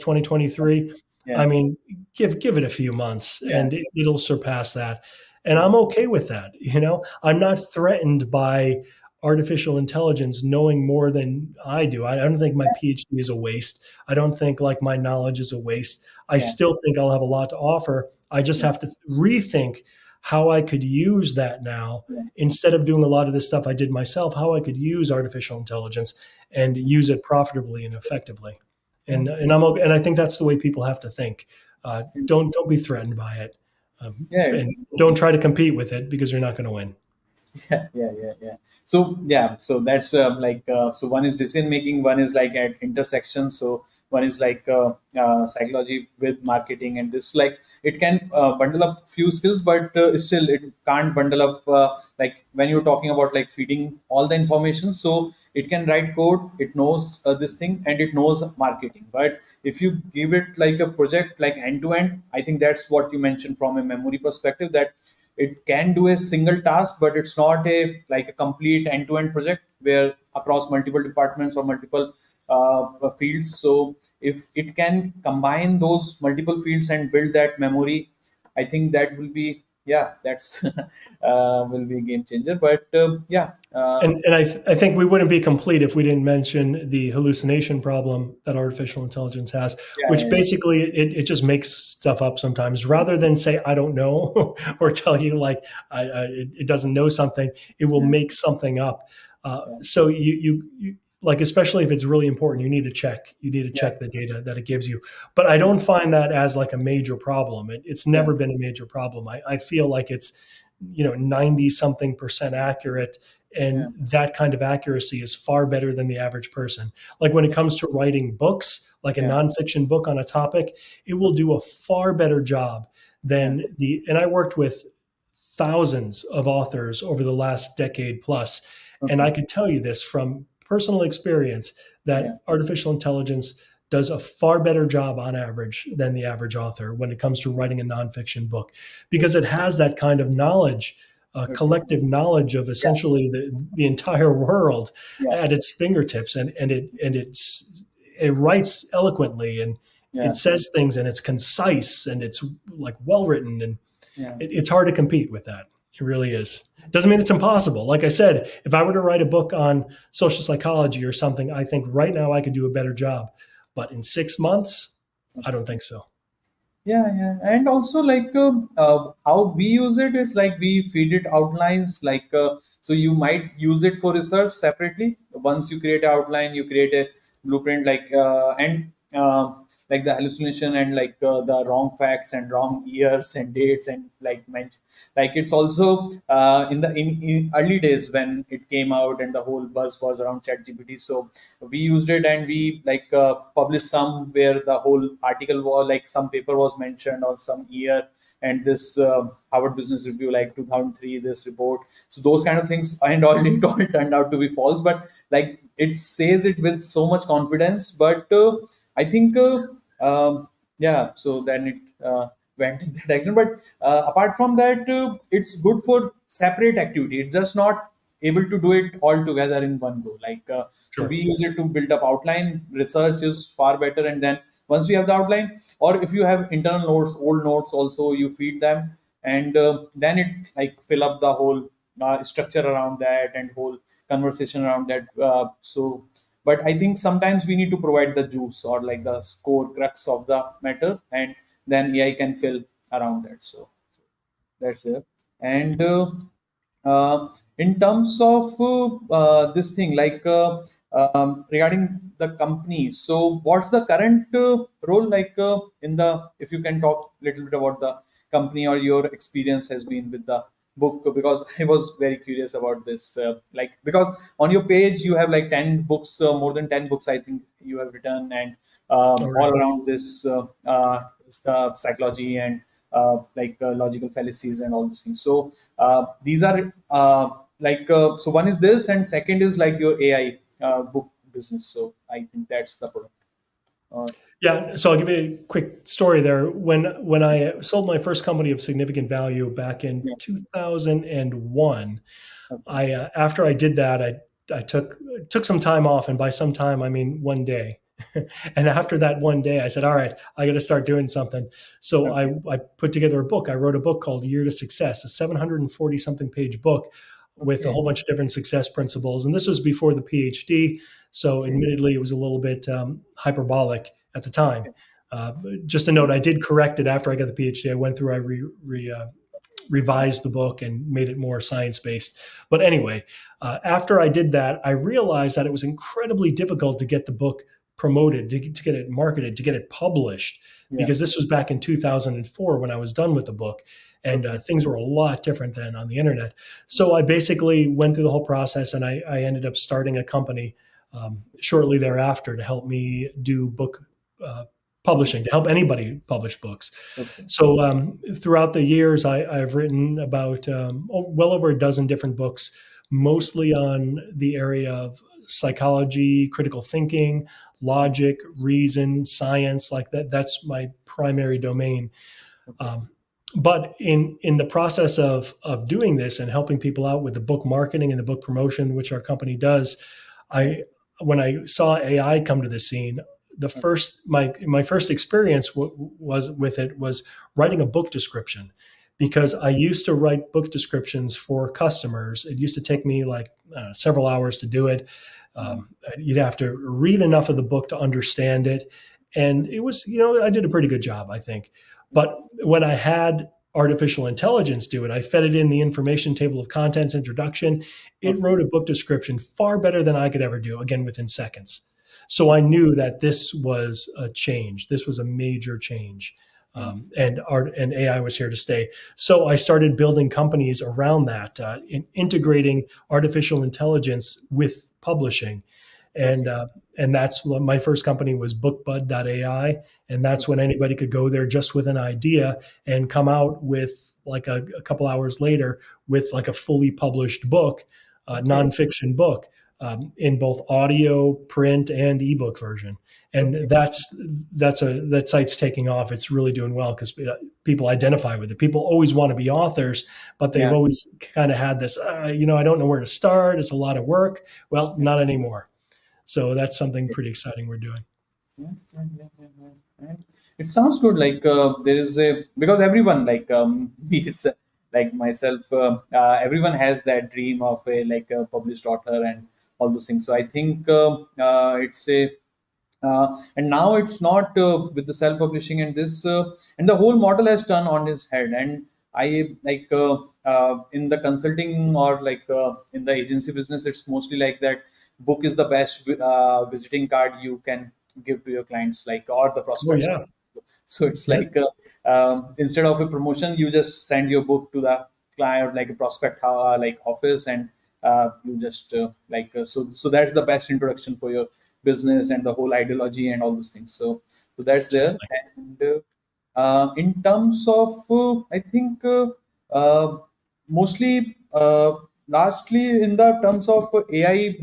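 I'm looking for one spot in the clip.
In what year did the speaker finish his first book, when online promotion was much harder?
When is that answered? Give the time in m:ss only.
5:31.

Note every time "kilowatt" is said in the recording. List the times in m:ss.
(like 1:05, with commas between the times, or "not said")
not said.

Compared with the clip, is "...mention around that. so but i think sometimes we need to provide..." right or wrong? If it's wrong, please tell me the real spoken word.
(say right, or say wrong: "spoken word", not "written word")
wrong: "conversation", not "mention".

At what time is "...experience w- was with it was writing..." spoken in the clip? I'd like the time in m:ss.
6:14.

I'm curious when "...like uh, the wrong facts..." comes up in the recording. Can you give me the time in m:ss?
3:00.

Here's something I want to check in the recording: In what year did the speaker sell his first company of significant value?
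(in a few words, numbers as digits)
2001.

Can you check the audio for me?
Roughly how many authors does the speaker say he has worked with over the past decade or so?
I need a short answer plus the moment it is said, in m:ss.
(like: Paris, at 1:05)
thousands, at 2:05.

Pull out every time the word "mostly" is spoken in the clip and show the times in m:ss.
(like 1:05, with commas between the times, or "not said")
5:52, 7:53, 8:20.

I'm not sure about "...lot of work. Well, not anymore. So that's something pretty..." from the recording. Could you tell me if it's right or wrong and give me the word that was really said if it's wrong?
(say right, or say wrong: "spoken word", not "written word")
right.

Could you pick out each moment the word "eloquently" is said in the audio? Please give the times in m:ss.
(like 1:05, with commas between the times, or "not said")
2:28.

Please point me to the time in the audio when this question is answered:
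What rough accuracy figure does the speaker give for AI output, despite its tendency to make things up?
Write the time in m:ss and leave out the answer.
1:51.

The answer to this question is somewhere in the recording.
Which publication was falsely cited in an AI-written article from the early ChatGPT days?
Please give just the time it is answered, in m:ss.
3:19.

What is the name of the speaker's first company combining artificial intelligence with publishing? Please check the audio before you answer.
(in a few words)
BookBud.ai.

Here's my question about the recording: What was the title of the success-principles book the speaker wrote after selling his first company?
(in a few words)
Year to Success.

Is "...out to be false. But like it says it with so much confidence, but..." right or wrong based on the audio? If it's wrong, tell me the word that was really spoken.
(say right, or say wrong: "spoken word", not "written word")
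right.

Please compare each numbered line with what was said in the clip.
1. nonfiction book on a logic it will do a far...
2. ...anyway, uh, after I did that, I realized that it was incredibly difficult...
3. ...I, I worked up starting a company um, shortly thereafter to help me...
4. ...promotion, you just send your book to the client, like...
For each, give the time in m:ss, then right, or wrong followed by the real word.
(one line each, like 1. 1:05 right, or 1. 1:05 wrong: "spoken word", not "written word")
1. 1:59 wrong: "topic", not "logic"
2. 5:22 right
3. 5:38 wrong: "ended", not "worked"
4. 8:02 right.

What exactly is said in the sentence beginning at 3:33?
But uh, apart from that, it's good for separate activity.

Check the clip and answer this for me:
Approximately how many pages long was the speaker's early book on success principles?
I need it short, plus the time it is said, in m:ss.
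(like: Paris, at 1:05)
740 something, at 5:05.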